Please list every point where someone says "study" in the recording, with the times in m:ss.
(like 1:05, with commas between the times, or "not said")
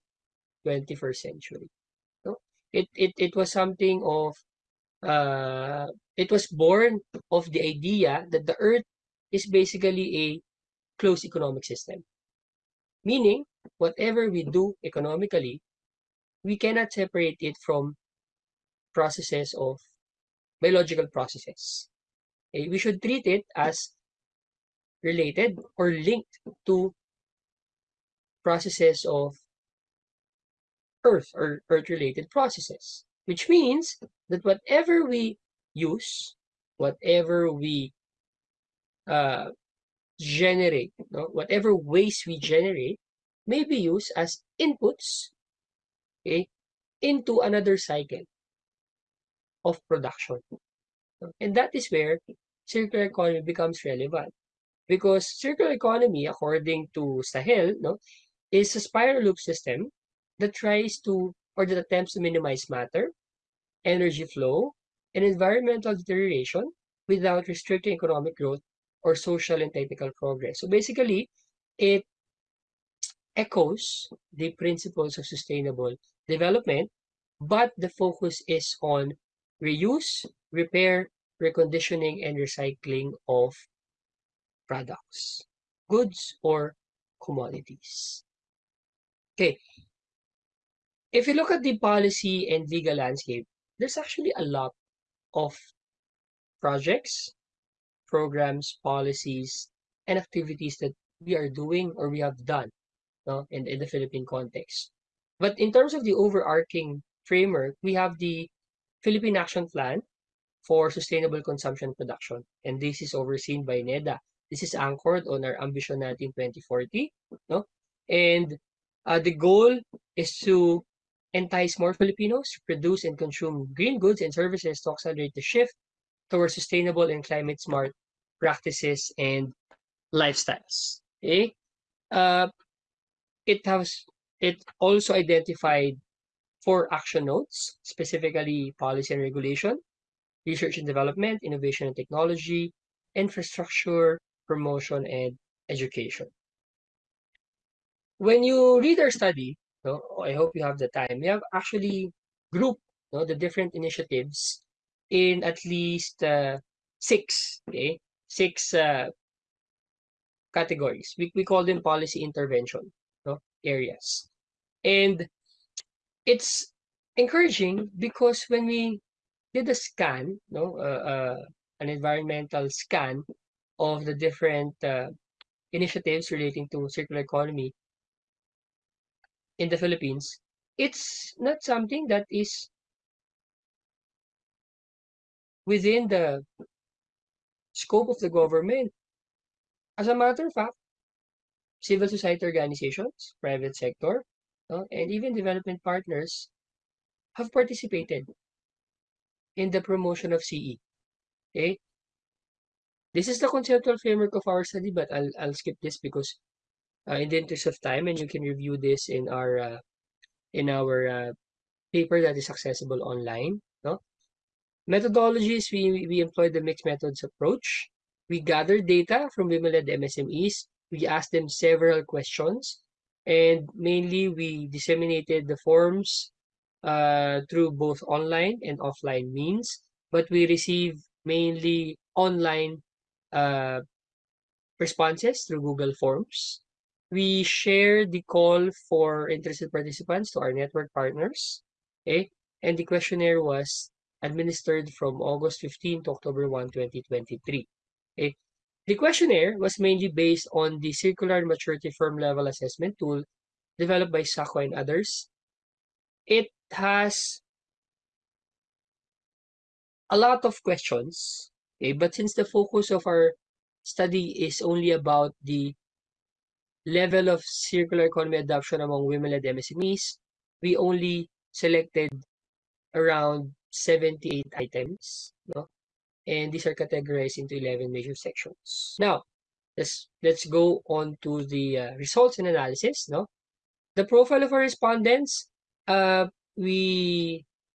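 2:29, 3:24, 4:23.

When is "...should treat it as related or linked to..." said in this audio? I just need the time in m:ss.
0:22.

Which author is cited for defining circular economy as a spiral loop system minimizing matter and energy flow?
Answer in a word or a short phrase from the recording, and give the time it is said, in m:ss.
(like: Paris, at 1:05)
Stahel, at 0:57.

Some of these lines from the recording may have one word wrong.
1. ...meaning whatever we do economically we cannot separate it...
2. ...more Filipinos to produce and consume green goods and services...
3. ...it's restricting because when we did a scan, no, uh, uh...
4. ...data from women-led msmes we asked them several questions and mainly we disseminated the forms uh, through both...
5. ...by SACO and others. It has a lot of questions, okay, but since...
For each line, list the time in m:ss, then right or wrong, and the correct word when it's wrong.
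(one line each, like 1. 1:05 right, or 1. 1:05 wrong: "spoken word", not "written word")
1. 0:13 right
2. 2:01 right
3. 2:46 wrong: "encouraging", not "restricting"
4. 3:38 right
5. 4:14 right.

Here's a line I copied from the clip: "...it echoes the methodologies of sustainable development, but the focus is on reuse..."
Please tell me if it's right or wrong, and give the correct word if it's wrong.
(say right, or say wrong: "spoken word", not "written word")
wrong: "principles", not "methodologies".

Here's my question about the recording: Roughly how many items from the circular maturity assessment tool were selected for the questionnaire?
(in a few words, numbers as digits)
78.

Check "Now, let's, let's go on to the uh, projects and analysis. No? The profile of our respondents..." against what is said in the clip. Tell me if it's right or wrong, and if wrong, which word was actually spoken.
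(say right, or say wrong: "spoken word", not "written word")
wrong: "results", not "projects".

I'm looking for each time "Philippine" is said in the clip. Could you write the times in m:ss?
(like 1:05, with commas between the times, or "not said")
1:43, 1:49, 2:59.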